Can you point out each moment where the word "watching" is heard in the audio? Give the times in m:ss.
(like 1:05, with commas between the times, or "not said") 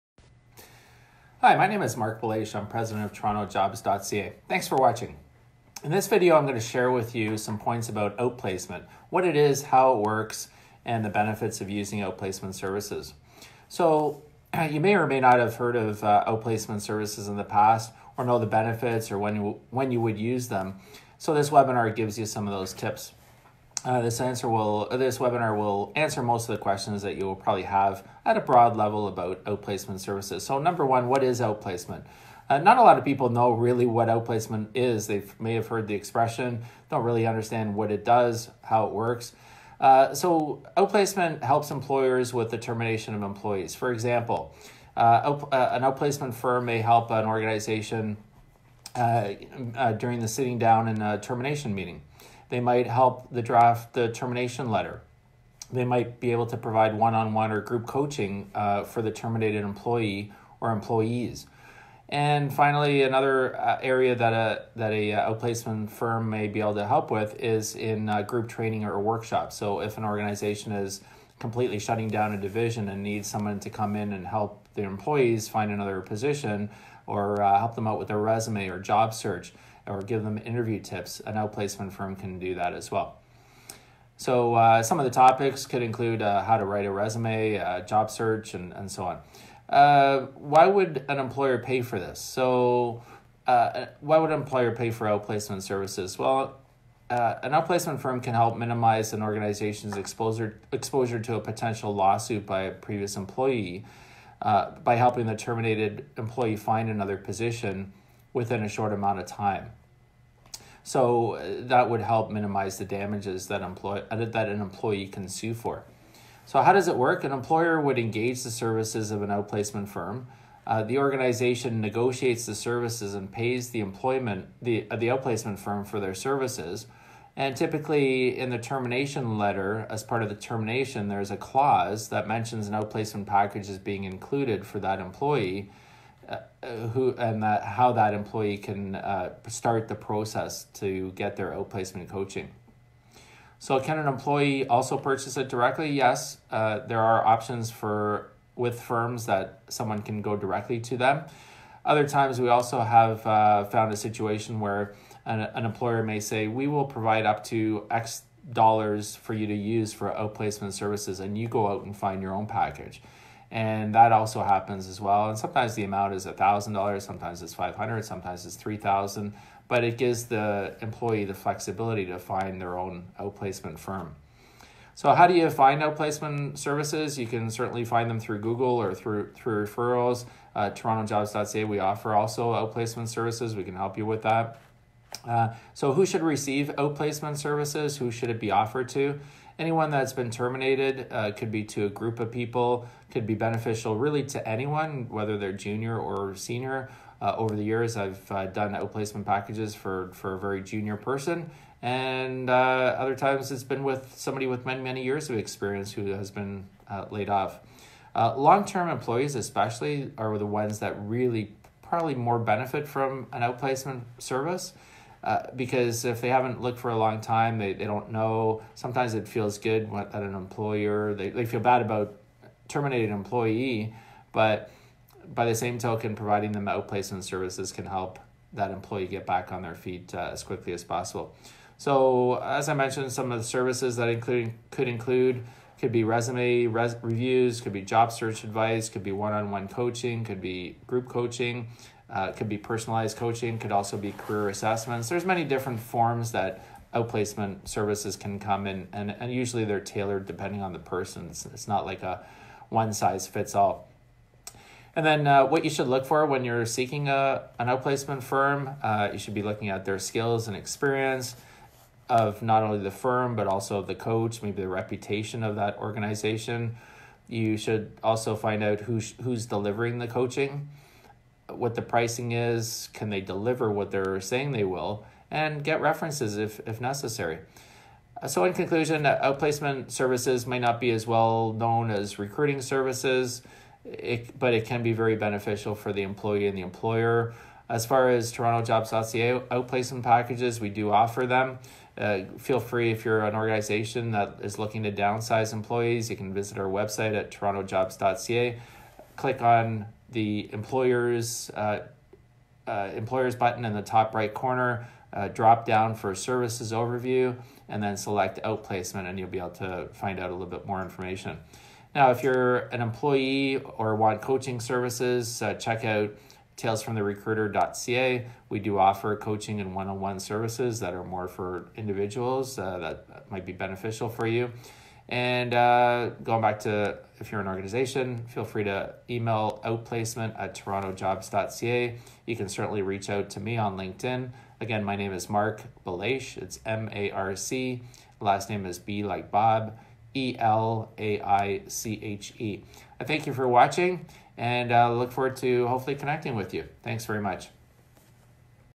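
0:04, 5:43.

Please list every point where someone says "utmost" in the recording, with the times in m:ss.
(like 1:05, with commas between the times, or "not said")
not said.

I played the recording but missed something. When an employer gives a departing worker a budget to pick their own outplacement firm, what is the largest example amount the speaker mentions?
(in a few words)
$3,000.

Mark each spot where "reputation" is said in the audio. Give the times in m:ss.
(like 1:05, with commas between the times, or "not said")
4:24.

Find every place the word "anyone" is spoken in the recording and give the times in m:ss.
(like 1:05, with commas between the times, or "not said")
3:09, 3:14.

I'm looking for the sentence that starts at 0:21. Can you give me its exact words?
So this webinar gives you some of those tips.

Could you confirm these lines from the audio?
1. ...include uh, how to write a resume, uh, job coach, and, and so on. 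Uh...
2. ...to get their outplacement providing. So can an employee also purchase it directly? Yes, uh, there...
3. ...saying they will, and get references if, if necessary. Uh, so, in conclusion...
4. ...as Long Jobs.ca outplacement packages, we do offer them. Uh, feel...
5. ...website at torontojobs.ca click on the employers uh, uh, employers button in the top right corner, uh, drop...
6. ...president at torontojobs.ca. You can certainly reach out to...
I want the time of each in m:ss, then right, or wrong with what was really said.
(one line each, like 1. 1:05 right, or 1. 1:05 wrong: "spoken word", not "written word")
1. 1:25 wrong: "search", not "coach"
2. 2:20 wrong: "coaching", not "providing"
3. 4:34 right
4. 4:48 wrong: "Toronto", not "Long"
5. 4:56 right
6. 5:29 wrong: "outplacement", not "president".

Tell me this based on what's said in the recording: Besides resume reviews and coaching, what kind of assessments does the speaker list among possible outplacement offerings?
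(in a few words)
Career assessments.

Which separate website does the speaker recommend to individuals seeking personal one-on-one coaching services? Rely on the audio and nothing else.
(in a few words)
talesfromtherecruiter.ca.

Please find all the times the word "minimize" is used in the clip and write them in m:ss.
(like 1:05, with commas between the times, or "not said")
1:38, 1:52.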